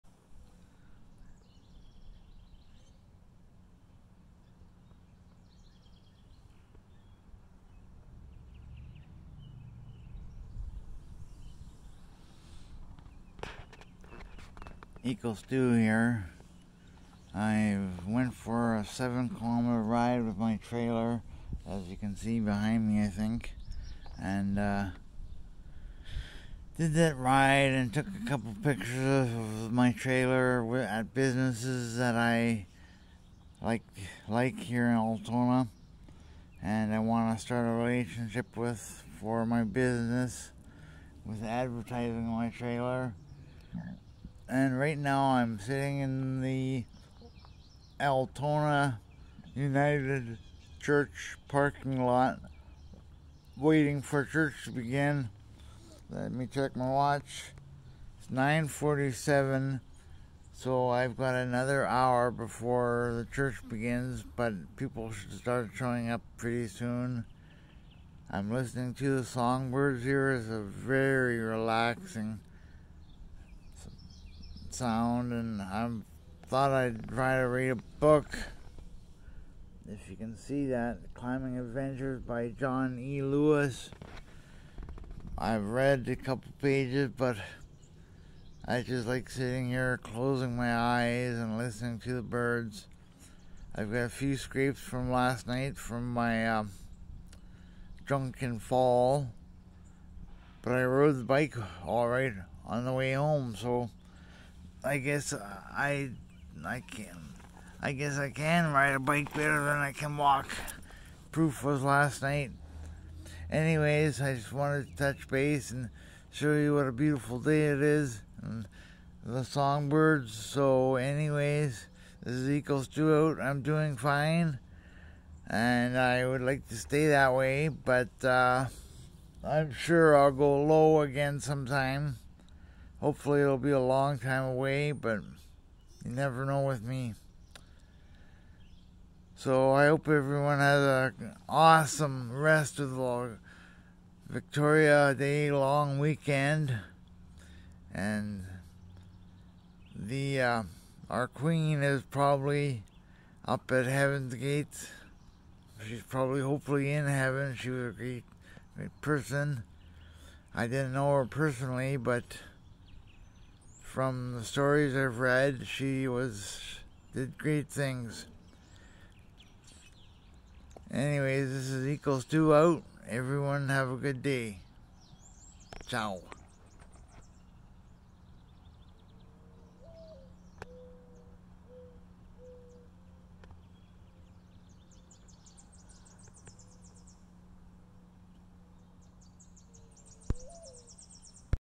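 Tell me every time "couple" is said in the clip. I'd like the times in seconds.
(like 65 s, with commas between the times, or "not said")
28 s, 86 s.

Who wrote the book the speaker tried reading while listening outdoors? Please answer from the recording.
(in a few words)
John E. Lewis.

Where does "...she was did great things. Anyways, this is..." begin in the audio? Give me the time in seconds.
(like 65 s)
165 s.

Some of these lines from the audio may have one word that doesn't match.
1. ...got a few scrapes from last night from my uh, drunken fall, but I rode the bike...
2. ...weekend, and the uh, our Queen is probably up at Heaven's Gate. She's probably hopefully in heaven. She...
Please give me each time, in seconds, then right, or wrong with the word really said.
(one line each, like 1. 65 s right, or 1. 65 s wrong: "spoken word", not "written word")
1. 93 s right
2. 145 s right.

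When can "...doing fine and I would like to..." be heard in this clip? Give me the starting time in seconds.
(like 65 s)
123 s.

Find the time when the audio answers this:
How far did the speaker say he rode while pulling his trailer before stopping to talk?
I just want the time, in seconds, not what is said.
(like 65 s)
18 s.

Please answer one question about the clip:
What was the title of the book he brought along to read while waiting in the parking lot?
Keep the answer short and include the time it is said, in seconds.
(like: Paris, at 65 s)
Climbing Adventures, at 81 s.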